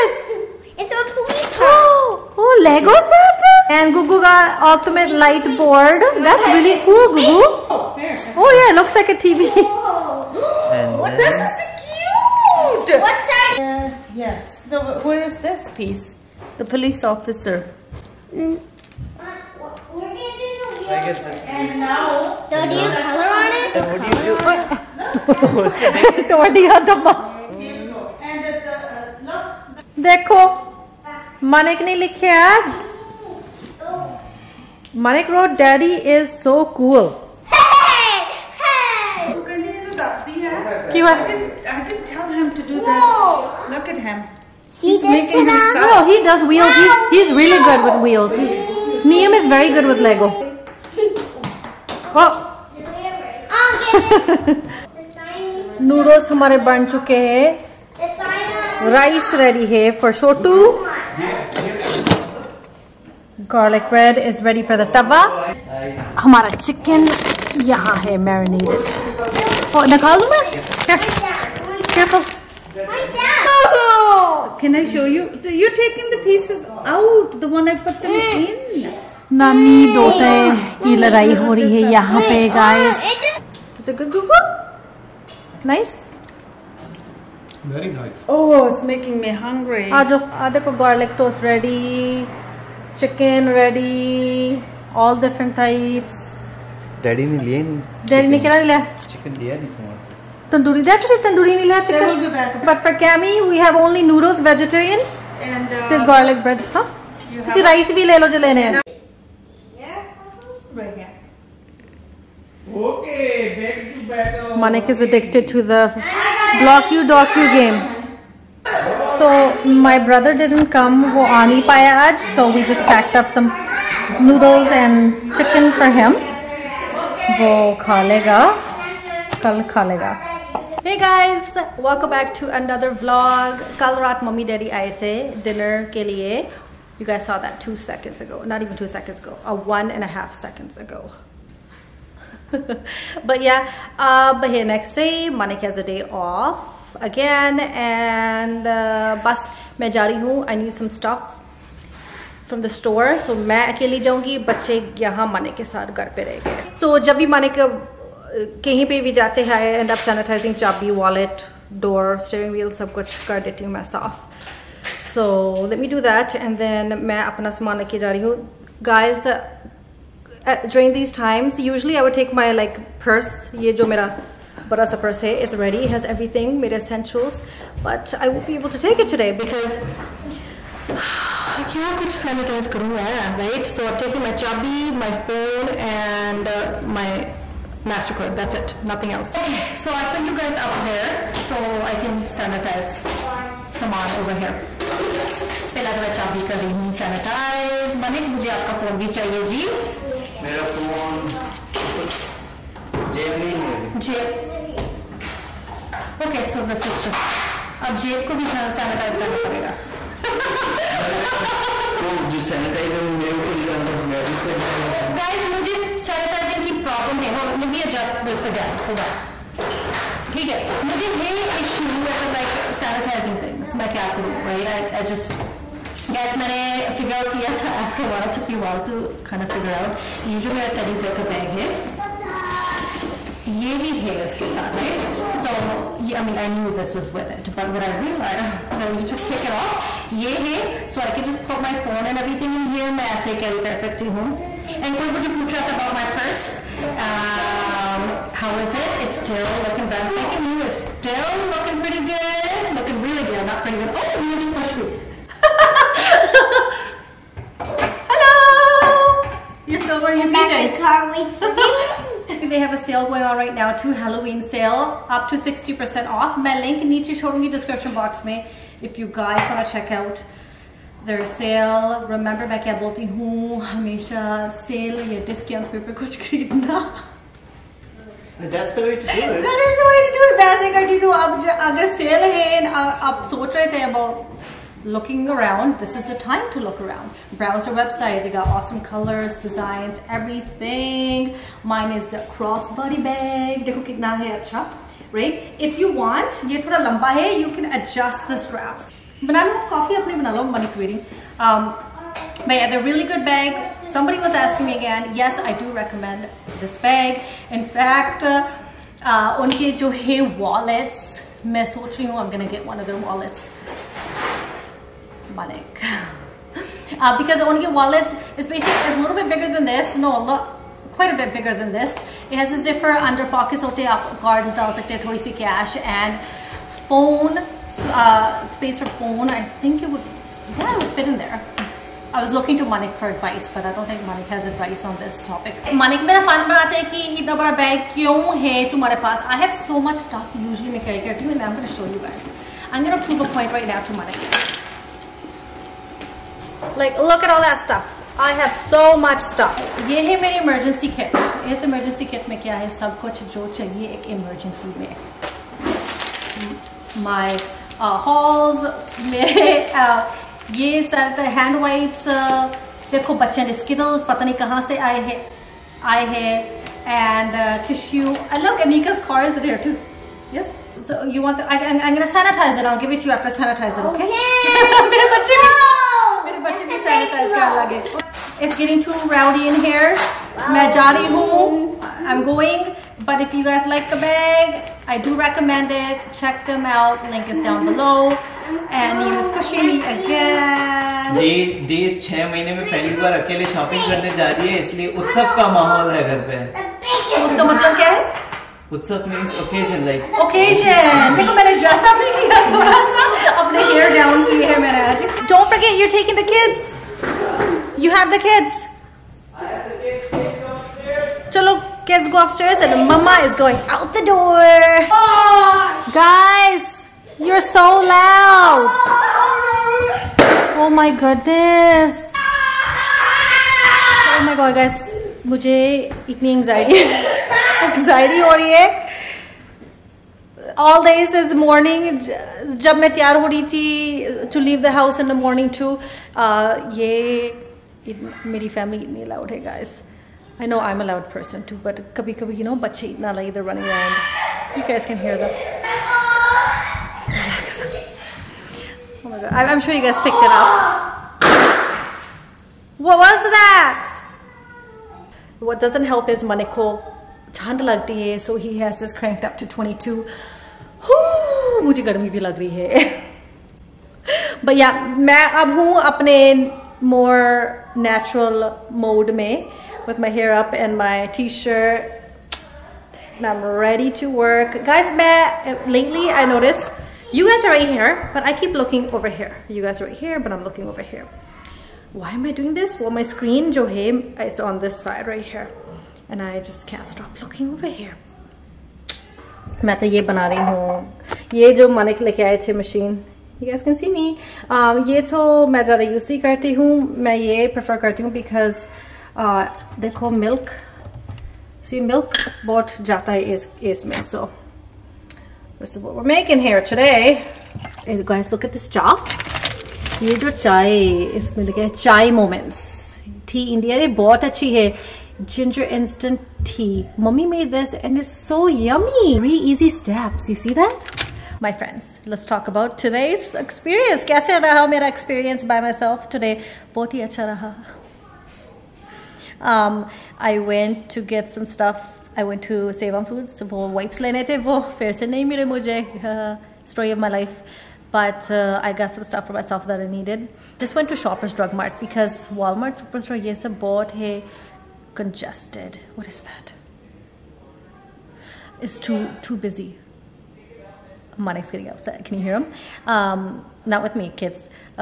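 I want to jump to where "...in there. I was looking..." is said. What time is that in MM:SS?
05:31.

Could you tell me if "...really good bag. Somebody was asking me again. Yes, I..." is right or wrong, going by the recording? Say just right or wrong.
right.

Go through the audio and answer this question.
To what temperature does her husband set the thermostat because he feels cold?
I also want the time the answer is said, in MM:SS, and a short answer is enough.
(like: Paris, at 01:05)
22, at 07:39.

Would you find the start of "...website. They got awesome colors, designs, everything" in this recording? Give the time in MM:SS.
04:47.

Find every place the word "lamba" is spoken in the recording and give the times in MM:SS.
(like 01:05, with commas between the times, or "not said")
04:56.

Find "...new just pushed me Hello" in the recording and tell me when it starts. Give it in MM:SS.
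04:14.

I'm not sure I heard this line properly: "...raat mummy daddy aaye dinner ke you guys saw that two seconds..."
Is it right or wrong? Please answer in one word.
right.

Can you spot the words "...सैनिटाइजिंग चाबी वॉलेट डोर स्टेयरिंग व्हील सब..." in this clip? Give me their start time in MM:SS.
02:40.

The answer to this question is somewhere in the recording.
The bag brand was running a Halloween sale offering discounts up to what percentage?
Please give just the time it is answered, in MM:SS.
04:25.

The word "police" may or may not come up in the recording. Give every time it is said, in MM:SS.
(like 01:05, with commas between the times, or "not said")
00:16.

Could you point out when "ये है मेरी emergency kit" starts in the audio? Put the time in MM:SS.
05:49.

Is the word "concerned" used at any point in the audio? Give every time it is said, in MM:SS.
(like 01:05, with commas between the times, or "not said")
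not said.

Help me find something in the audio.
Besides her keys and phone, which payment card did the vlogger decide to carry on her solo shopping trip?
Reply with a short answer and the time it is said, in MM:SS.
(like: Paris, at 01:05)
MasterCard, at 03:07.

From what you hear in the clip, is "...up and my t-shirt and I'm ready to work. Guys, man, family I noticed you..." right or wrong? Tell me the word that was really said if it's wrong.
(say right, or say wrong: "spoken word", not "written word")
wrong: "lately", not "family".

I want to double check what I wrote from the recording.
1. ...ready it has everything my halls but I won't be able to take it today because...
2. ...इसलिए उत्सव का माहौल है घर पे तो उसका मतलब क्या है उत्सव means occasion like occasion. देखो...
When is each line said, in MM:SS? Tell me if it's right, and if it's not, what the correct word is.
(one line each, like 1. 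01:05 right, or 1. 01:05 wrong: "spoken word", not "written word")
1. 02:55 wrong: "essentials", not "halls"
2. 06:34 right.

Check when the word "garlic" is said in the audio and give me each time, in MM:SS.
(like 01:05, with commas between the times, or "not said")
01:03, 01:30, 01:46.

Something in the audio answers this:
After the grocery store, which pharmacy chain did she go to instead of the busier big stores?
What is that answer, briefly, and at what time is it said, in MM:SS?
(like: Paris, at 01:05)
Shoppers Drug Mart, at 09:01.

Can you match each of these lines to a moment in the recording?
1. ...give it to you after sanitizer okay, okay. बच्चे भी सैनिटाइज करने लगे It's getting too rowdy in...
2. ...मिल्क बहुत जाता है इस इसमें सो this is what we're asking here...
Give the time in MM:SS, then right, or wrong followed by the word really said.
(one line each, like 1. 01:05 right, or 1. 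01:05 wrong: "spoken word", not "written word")
1. 06:12 right
2. 08:21 wrong: "making", not "asking".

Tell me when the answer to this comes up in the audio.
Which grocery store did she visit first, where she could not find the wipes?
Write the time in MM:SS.
08:52.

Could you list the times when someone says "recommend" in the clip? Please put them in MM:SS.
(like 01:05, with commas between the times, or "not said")
05:05, 06:25.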